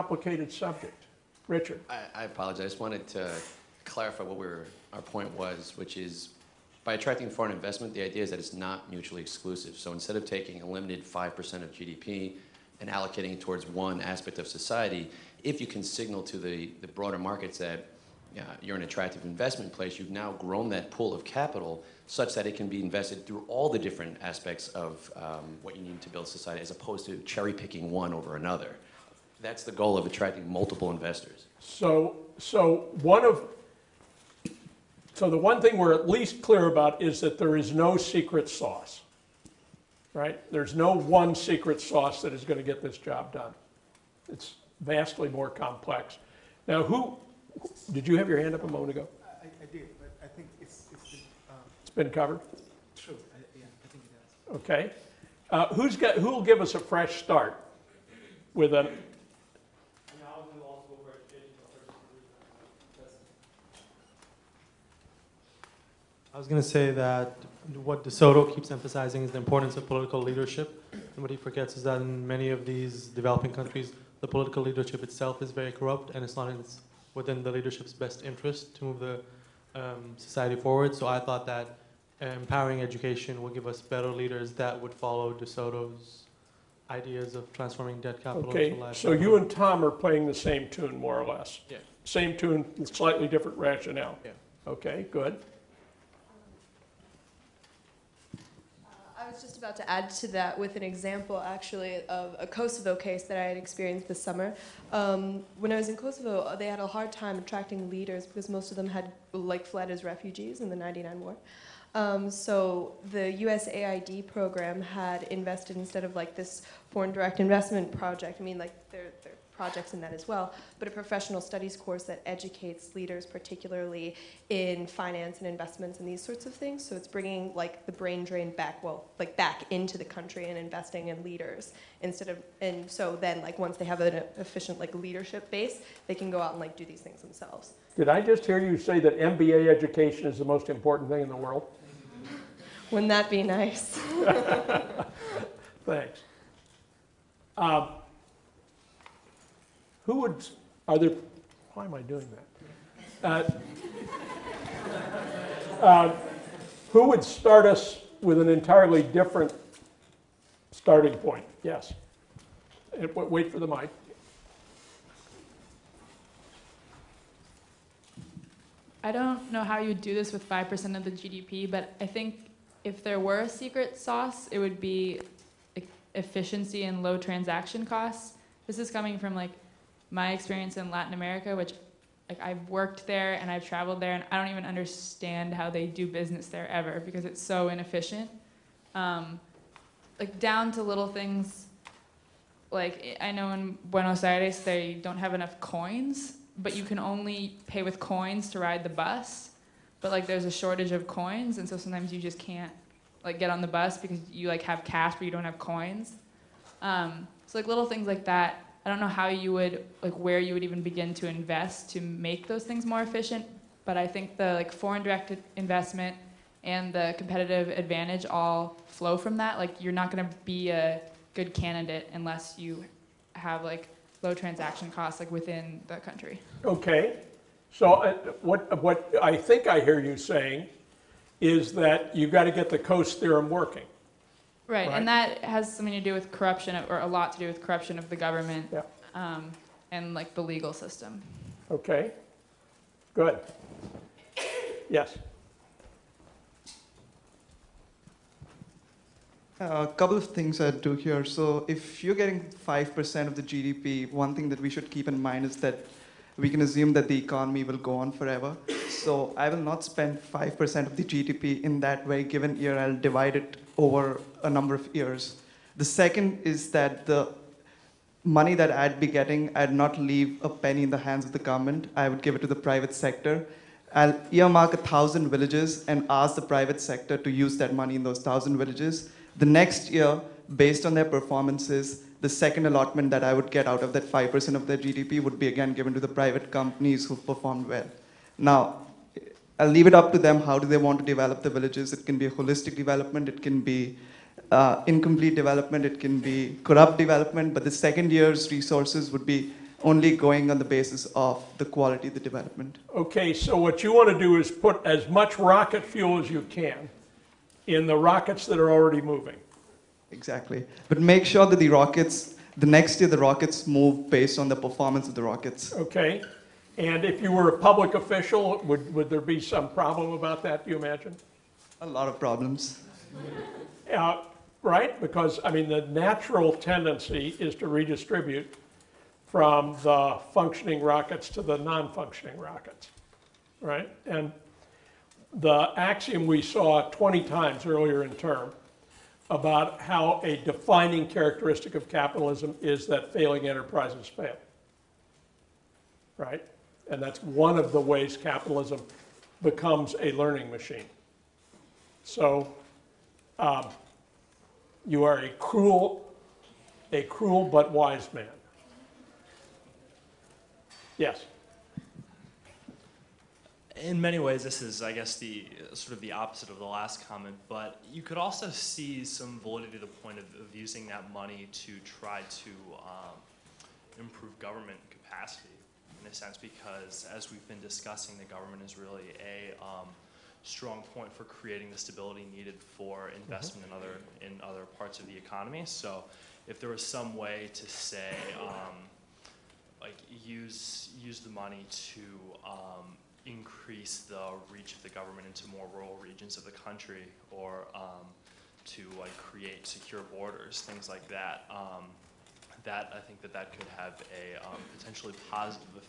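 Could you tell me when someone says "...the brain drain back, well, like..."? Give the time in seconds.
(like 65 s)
127 s.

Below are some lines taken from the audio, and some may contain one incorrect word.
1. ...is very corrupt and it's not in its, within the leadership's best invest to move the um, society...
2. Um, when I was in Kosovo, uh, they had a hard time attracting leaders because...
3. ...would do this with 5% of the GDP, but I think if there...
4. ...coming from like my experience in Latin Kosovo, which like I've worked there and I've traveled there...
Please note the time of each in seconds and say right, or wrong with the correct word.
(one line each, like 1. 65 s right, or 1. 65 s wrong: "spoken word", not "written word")
1. 75 s wrong: "interest", not "invest"
2. 104 s right
3. 169 s right
4. 178 s wrong: "America", not "Kosovo".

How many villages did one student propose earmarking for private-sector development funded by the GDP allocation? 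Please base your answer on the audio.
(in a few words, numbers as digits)
1000.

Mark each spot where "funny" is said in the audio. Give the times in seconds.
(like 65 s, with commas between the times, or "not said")
not said.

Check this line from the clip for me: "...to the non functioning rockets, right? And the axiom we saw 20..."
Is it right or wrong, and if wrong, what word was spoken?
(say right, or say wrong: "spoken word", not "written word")
right.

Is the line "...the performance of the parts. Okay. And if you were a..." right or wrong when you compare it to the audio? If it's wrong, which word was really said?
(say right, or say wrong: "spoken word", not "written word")
wrong: "rockets", not "parts".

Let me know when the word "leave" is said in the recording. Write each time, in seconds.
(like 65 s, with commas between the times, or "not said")
269 s, 289 s.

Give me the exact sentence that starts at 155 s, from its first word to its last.
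Uh, uh, who would start us with an entirely different starting point?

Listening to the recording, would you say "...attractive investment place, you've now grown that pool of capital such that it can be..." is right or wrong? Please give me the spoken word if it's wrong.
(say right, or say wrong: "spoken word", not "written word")
right.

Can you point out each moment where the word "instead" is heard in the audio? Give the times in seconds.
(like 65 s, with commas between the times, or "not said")
9 s, 115 s, 132 s.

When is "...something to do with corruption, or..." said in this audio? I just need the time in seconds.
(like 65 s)
235 s.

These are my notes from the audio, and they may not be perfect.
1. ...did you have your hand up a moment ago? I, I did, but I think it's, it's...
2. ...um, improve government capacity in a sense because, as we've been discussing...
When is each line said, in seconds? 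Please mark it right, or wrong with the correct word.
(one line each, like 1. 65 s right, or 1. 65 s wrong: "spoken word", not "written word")
1. 47 s right
2. 372 s right.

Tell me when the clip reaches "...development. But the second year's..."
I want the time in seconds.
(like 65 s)
296 s.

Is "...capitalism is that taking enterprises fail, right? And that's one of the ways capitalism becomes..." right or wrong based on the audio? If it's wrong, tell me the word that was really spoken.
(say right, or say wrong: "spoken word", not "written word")
wrong: "failing", not "taking".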